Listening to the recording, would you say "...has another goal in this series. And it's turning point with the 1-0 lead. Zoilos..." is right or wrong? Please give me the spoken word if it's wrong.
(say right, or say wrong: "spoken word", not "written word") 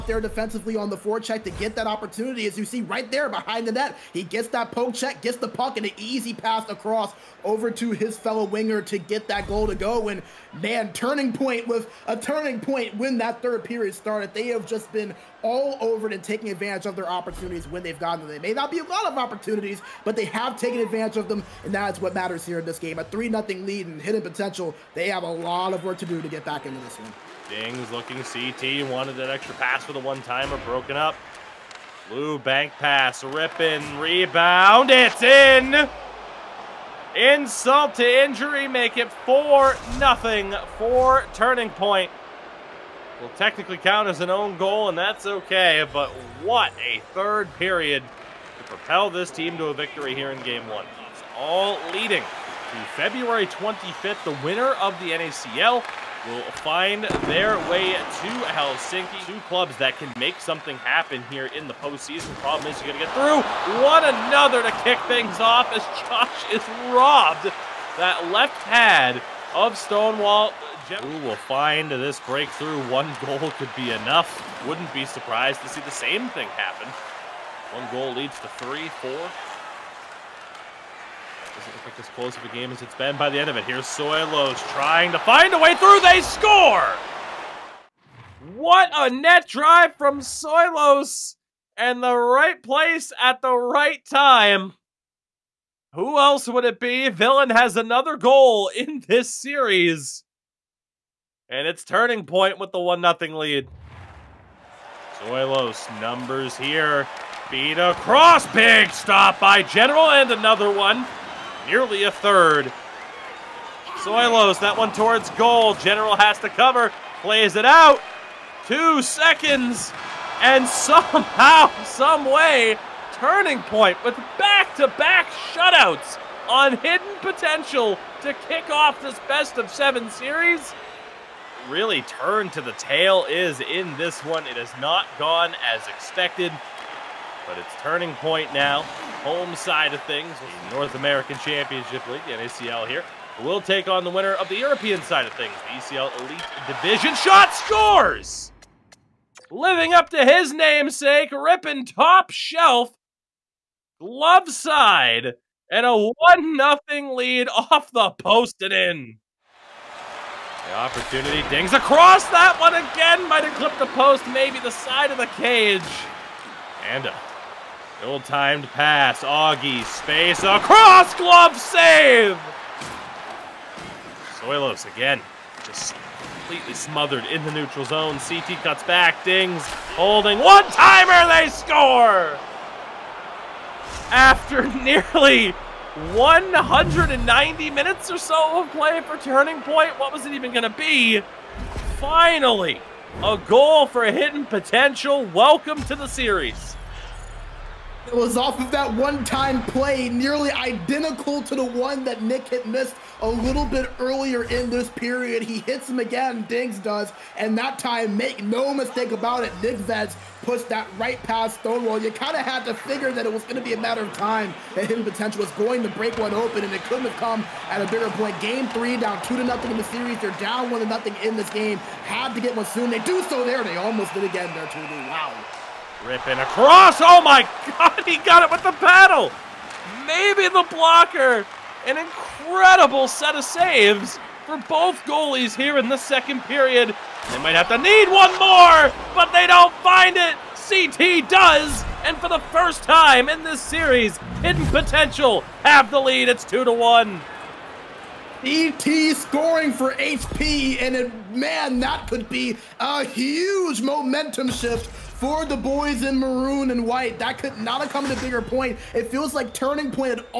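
right.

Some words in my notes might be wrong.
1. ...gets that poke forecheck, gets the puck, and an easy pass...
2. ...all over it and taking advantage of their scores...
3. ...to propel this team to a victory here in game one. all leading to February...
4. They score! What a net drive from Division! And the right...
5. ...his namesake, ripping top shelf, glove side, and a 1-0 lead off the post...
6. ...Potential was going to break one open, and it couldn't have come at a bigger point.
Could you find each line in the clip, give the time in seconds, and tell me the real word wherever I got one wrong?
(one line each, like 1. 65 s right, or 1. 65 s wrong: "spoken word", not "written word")
1. 4 s wrong: "check", not "forecheck"
2. 15 s wrong: "opportunities", not "scores"
3. 48 s right
4. 86 s wrong: "Soilos", not "Division"
5. 150 s right
6. 215 s right.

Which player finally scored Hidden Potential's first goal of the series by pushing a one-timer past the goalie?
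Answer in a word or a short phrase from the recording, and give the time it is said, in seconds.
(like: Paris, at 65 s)
Nick Veds, at 209 s.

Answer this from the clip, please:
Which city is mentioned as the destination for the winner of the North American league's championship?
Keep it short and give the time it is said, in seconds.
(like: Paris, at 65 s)
Helsinki, at 58 s.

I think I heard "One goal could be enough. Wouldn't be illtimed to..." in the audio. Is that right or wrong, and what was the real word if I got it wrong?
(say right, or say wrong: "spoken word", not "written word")
wrong: "surprised", not "illtimed".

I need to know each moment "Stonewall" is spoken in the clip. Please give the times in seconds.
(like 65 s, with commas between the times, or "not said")
69 s, 211 s.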